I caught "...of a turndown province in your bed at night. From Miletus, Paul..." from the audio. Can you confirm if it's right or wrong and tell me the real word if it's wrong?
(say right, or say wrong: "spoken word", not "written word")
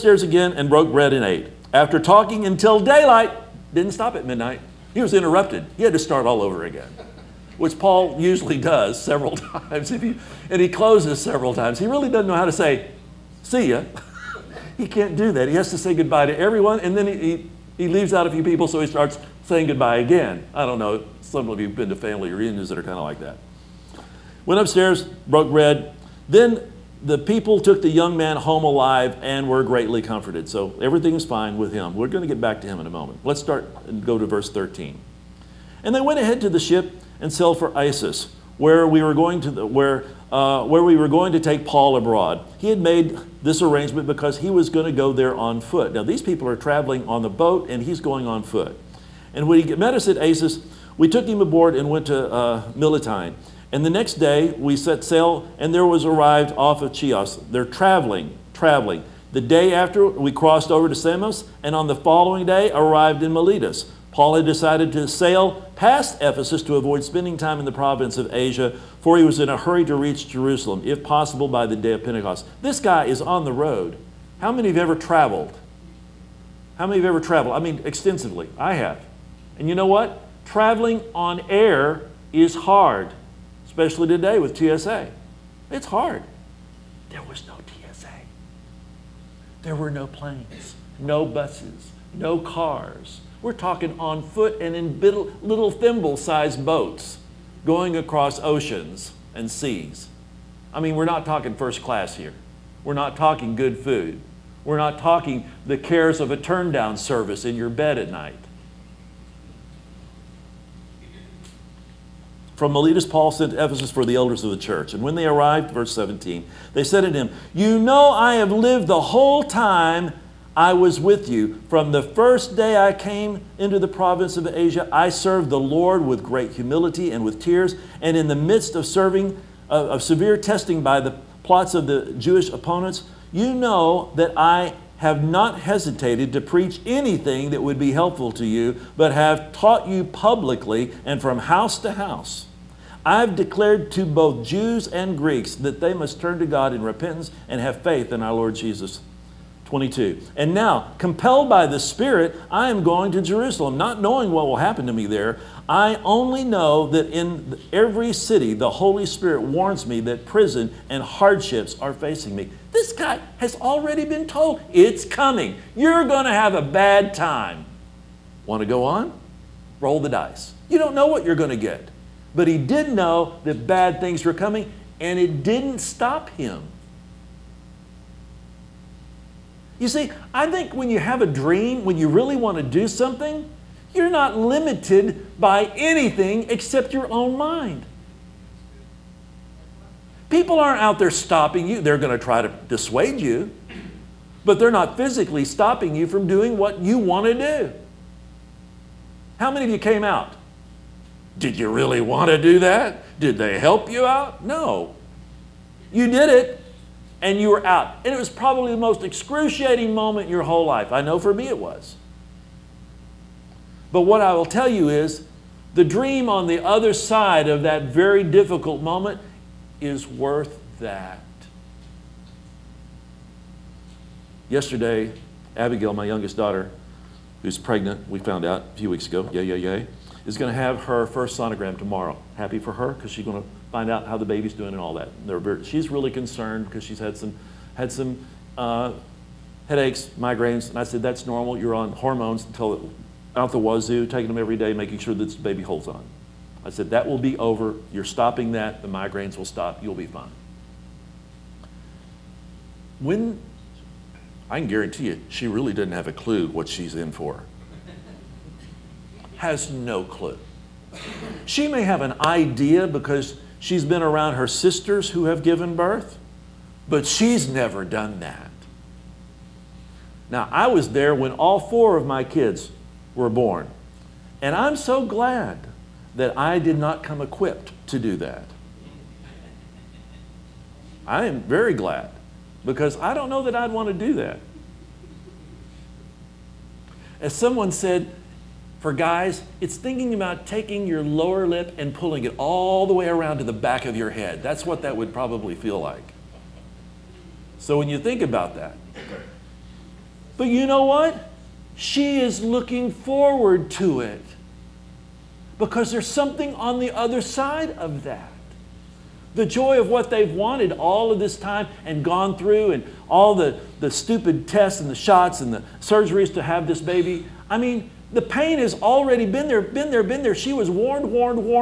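wrong: "service", not "province".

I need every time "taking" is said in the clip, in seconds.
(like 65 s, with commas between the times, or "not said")
244 s, 290 s.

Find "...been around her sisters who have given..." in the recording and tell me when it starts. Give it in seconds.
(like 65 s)
263 s.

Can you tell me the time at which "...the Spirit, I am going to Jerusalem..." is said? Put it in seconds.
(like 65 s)
151 s.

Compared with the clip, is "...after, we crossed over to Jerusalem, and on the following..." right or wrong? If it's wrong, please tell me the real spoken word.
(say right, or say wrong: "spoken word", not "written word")
wrong: "Samos", not "Jerusalem".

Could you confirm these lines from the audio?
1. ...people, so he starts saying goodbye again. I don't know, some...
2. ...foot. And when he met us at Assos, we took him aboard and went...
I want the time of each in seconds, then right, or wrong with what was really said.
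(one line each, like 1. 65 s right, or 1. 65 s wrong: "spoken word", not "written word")
1. 18 s right
2. 48 s right.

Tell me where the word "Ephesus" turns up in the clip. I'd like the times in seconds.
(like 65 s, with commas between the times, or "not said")
66 s, 113 s.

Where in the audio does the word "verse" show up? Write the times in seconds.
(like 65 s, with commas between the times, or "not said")
34 s, 115 s.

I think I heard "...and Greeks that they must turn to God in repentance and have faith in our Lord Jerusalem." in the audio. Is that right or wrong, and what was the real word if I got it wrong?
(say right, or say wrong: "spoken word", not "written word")
wrong: "Jesus", not "Jerusalem".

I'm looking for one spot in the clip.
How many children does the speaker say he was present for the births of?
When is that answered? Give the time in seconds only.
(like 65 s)
271 s.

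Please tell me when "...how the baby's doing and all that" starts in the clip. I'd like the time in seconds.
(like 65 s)
234 s.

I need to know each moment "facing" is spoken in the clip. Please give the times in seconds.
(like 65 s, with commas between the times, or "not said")
161 s.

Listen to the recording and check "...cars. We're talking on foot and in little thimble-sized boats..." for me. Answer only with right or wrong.
right.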